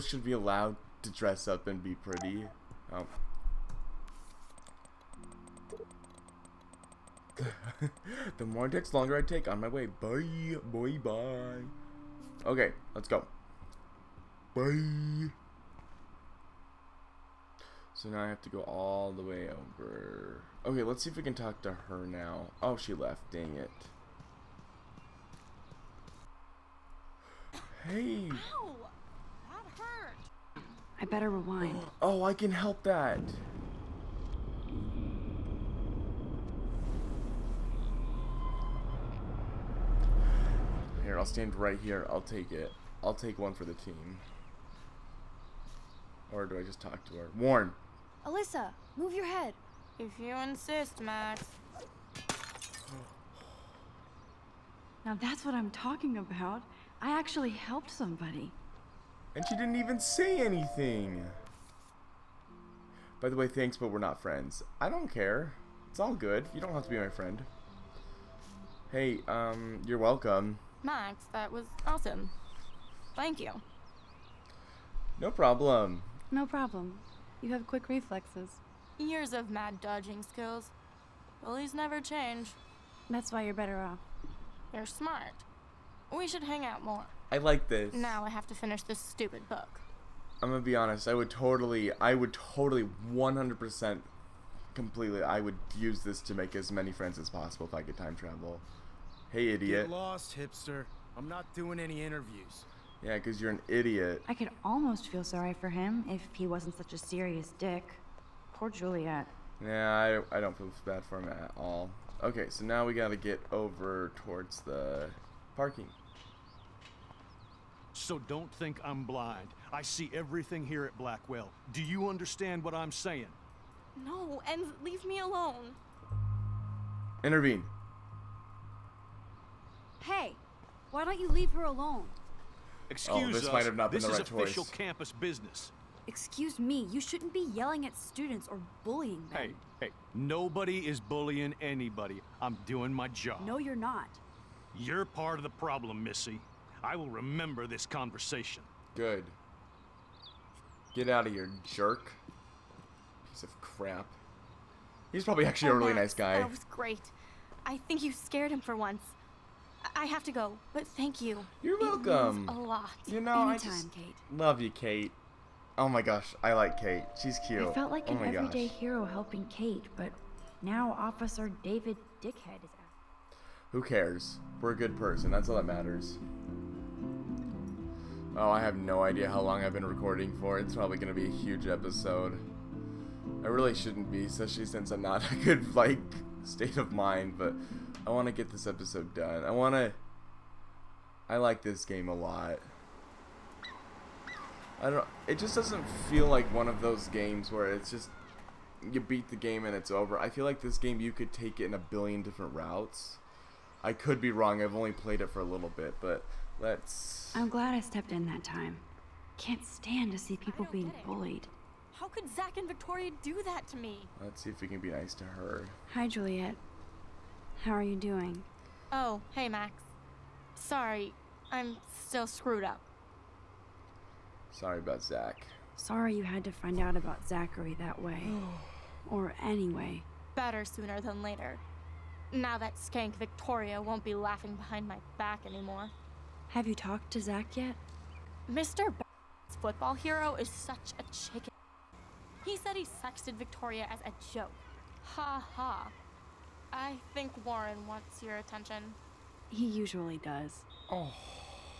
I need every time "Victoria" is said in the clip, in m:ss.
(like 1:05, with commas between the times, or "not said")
3:32, 3:53, 4:03.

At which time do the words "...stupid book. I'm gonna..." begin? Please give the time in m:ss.
1:28.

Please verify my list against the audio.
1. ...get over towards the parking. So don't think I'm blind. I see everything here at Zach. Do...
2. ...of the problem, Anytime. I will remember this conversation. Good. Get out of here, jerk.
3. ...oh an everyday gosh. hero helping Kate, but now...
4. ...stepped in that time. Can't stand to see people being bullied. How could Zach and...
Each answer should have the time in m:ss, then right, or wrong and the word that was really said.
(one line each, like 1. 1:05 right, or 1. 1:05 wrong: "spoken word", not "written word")
1. 1:53 wrong: "Blackwell", not "Zach"
2. 2:25 wrong: "Missy", not "Anytime"
3. 2:48 right
4. 3:27 right.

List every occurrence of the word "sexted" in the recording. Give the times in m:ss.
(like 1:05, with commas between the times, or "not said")
4:02.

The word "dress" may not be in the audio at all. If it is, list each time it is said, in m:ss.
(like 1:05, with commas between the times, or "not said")
0:01.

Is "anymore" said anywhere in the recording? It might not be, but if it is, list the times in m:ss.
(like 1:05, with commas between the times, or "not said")
3:55.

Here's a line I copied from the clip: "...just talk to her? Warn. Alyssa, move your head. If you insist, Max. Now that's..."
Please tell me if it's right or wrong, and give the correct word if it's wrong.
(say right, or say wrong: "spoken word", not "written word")
right.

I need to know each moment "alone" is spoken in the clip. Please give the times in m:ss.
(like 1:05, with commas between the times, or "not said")
2:05, 2:11.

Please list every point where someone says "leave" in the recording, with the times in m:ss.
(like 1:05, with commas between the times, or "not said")
2:04, 2:11.